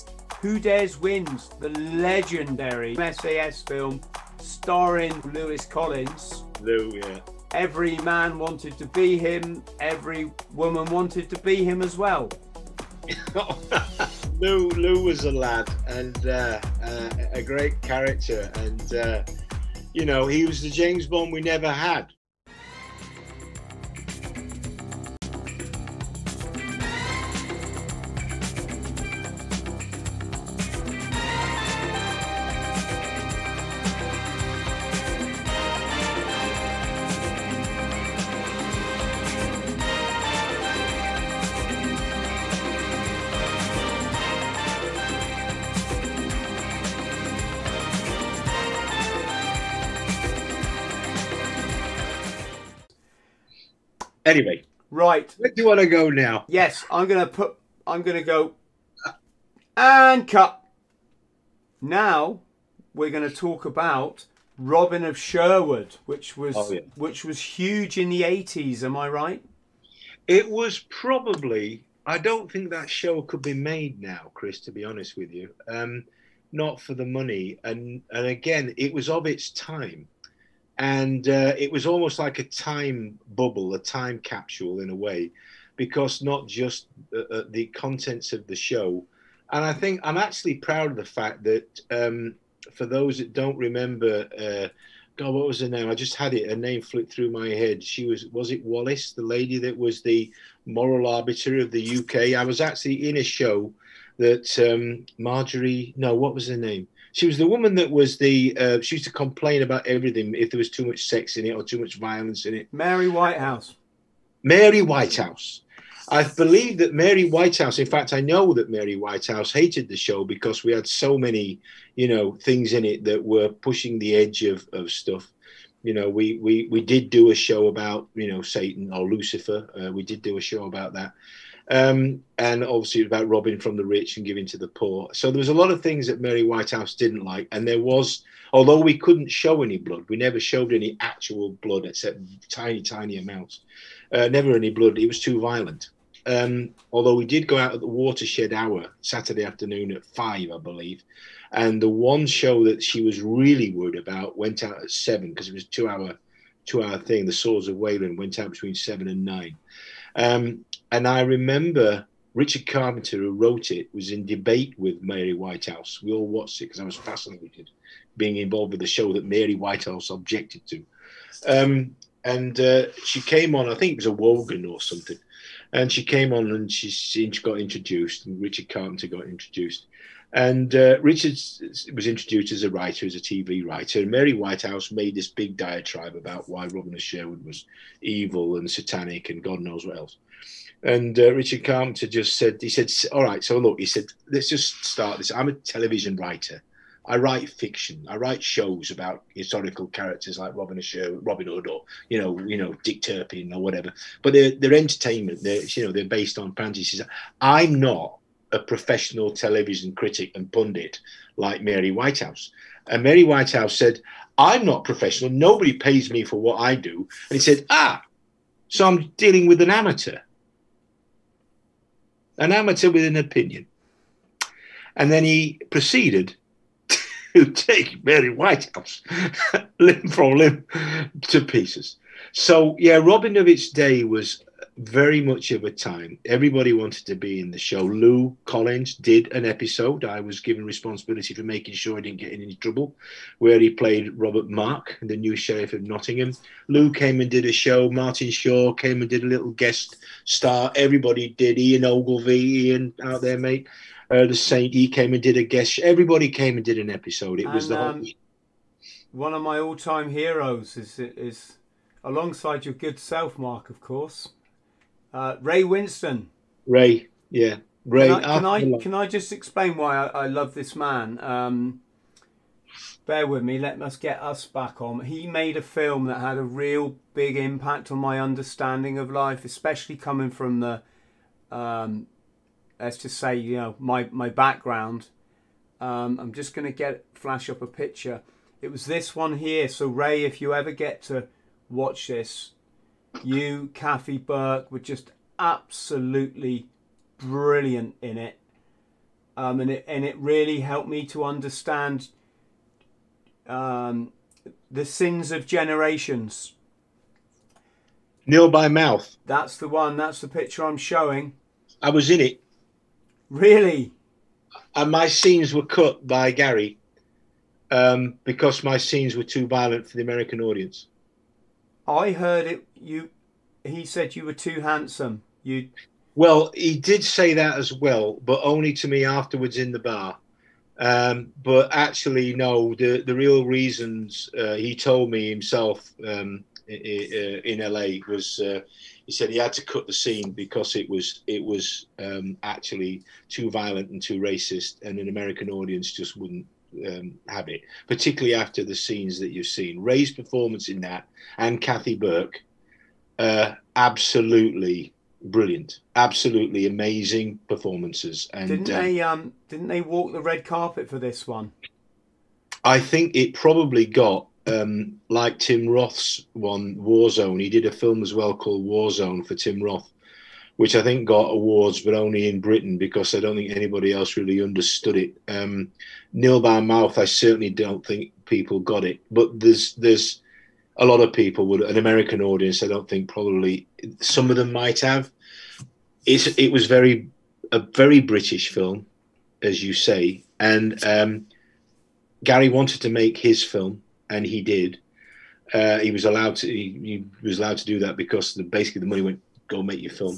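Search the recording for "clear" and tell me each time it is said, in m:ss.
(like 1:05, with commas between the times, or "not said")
not said.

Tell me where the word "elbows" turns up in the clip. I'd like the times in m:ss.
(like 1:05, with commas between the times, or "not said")
not said.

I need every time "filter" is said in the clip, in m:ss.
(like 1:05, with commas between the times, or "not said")
not said.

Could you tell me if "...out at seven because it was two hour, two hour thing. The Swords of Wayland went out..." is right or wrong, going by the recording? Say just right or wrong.
right.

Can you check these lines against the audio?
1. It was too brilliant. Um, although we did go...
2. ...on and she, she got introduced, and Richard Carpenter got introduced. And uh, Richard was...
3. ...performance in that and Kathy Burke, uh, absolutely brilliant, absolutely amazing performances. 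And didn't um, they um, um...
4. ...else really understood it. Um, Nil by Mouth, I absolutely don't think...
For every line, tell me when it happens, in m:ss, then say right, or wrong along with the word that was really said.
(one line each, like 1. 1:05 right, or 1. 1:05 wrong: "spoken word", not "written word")
1. 2:24 wrong: "violent", not "brilliant"
2. 2:56 right
3. 5:50 right
4. 6:13 wrong: "certainly", not "absolutely".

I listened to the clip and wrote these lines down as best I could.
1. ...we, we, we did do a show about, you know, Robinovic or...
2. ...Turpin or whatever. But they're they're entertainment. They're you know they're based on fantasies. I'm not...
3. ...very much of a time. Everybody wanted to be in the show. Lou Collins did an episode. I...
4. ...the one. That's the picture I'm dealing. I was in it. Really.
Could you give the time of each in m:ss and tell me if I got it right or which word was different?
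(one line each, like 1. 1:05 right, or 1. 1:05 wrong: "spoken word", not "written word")
1. 2:06 wrong: "Satan", not "Robinovic"
2. 3:23 right
3. 3:54 right
4. 5:09 wrong: "showing", not "dealing".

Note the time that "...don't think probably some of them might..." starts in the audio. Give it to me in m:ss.
6:22.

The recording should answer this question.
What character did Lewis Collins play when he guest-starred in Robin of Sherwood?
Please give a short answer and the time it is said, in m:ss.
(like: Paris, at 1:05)
Robert Mark, the new sheriff of Nottingham, at 4:04.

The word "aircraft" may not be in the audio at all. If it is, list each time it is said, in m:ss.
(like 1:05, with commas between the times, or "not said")
not said.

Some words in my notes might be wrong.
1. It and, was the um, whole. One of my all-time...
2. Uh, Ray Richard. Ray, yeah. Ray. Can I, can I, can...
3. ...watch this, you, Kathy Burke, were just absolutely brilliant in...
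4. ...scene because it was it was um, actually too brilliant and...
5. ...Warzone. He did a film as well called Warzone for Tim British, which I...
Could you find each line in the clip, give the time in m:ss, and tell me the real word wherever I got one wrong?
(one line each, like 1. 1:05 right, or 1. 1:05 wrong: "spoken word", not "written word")
1. 4:17 right
2. 4:25 wrong: "Winstone", not "Richard"
3. 4:51 right
4. 5:39 wrong: "violent", not "brilliant"
5. 6:06 wrong: "Roth", not "British".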